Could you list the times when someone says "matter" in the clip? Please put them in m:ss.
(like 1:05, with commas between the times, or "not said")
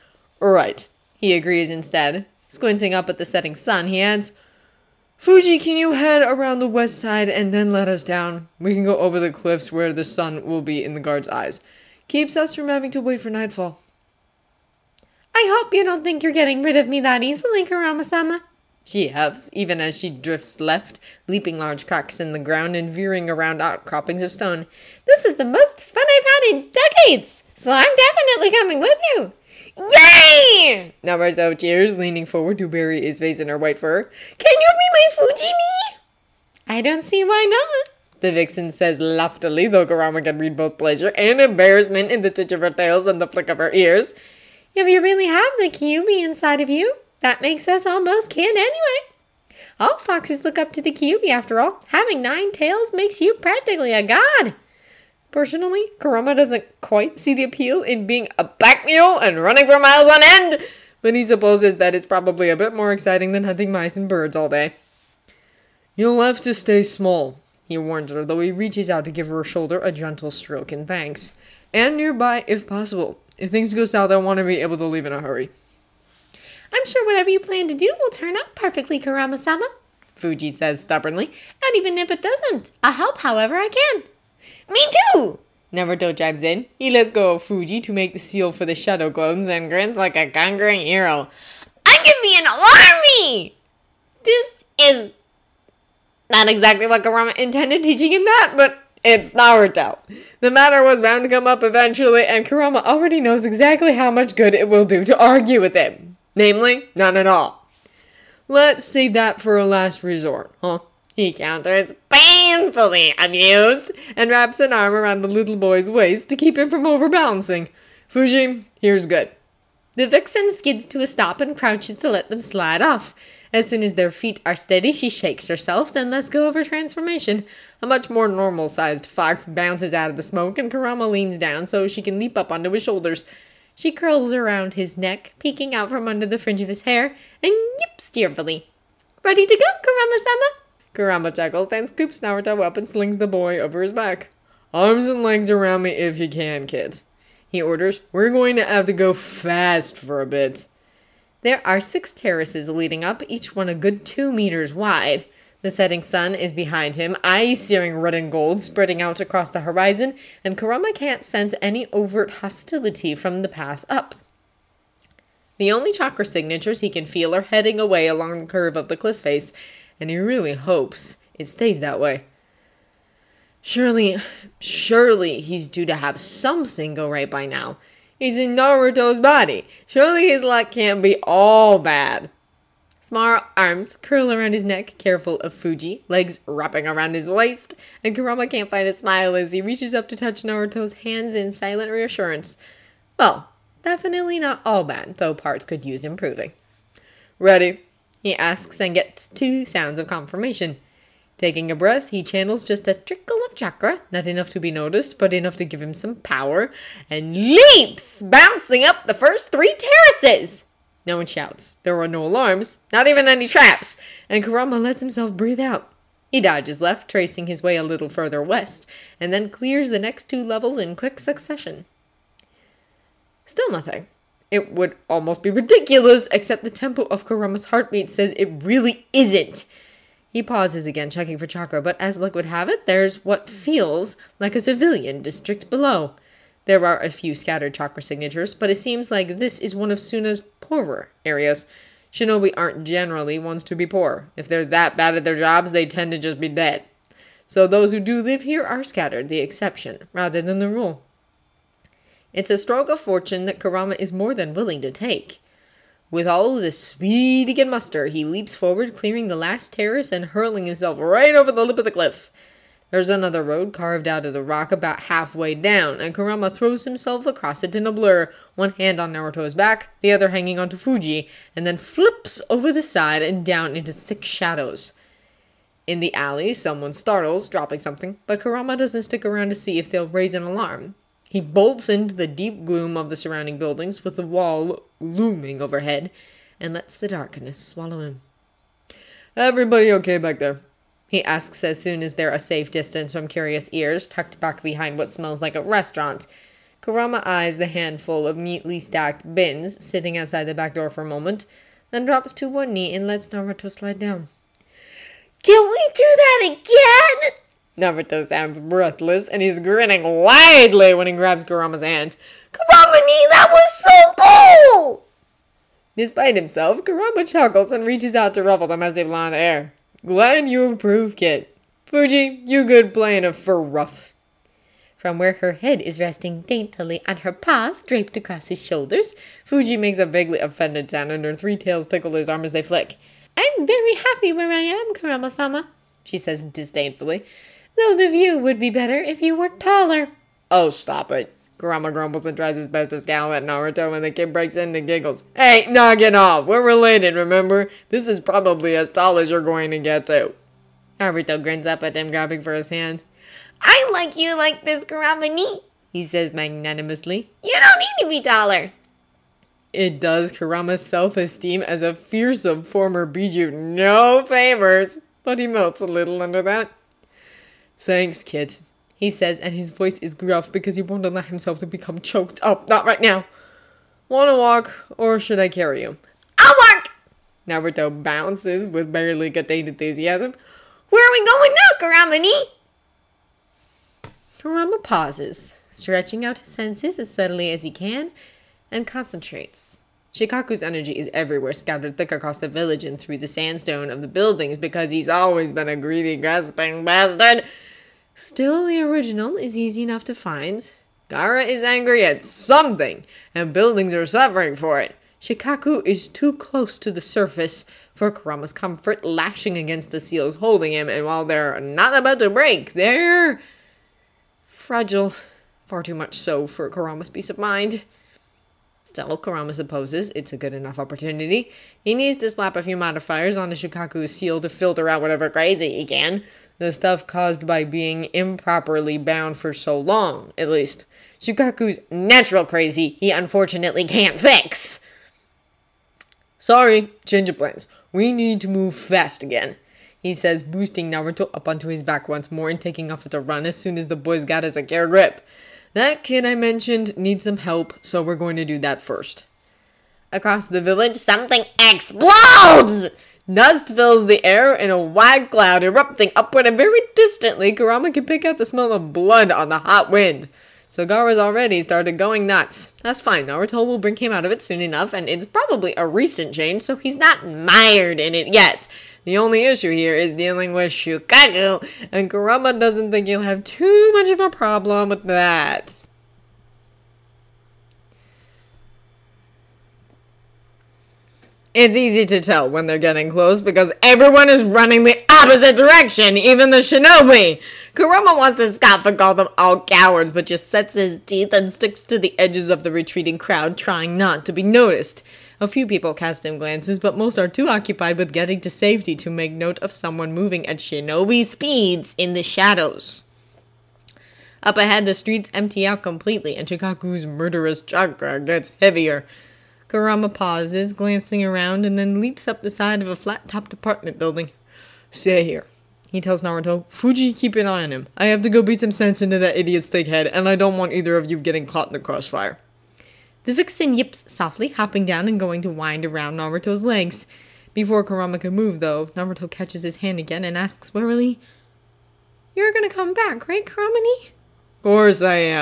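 1:40.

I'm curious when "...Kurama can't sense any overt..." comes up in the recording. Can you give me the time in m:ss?
2:40.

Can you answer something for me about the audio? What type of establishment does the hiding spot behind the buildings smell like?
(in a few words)
A restaurant.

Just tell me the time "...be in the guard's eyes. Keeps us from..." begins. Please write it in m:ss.
0:10.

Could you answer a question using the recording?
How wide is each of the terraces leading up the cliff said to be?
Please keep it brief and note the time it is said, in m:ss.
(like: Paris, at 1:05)
2 meters, at 2:34.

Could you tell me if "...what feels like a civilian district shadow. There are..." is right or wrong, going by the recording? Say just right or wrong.
wrong.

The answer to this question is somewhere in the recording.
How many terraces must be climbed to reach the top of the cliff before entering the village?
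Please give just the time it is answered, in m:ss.
2:31.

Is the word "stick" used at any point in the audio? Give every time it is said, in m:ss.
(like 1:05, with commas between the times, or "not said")
4:39, 8:11.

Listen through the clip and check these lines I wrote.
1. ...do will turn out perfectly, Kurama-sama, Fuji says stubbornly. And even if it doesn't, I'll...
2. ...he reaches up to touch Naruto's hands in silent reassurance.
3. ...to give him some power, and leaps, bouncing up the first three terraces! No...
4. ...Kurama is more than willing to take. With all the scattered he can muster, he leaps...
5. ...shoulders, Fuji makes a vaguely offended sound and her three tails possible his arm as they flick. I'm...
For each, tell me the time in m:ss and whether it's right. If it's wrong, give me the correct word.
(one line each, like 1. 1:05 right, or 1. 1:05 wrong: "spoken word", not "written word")
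1. 1:17 right
2. 3:09 right
3. 3:25 right
4. 4:13 wrong: "speed", not "scattered"
5. 5:28 wrong: "tickle", not "possible".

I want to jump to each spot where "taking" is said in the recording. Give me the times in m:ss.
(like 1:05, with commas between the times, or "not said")
3:21, 7:22.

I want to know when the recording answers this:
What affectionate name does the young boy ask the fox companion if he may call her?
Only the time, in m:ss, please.
0:35.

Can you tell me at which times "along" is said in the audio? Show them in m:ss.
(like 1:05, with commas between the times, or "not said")
2:48.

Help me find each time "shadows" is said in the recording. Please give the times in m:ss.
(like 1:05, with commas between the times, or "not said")
1:28, 4:34, 8:22.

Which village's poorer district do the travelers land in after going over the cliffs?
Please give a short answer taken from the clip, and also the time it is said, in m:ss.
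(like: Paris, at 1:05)
Suna, at 3:59.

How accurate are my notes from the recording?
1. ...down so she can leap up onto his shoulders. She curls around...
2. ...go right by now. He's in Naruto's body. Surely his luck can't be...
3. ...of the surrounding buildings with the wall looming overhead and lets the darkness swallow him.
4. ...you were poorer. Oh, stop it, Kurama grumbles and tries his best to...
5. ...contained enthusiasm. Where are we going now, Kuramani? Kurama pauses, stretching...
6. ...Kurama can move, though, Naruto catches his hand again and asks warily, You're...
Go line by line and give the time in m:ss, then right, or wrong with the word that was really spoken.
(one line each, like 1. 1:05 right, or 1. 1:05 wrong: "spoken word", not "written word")
1. 2:11 right
2. 2:56 right
3. 4:42 right
4. 5:39 wrong: "taller", not "poorer"
5. 6:19 right
6. 8:47 right.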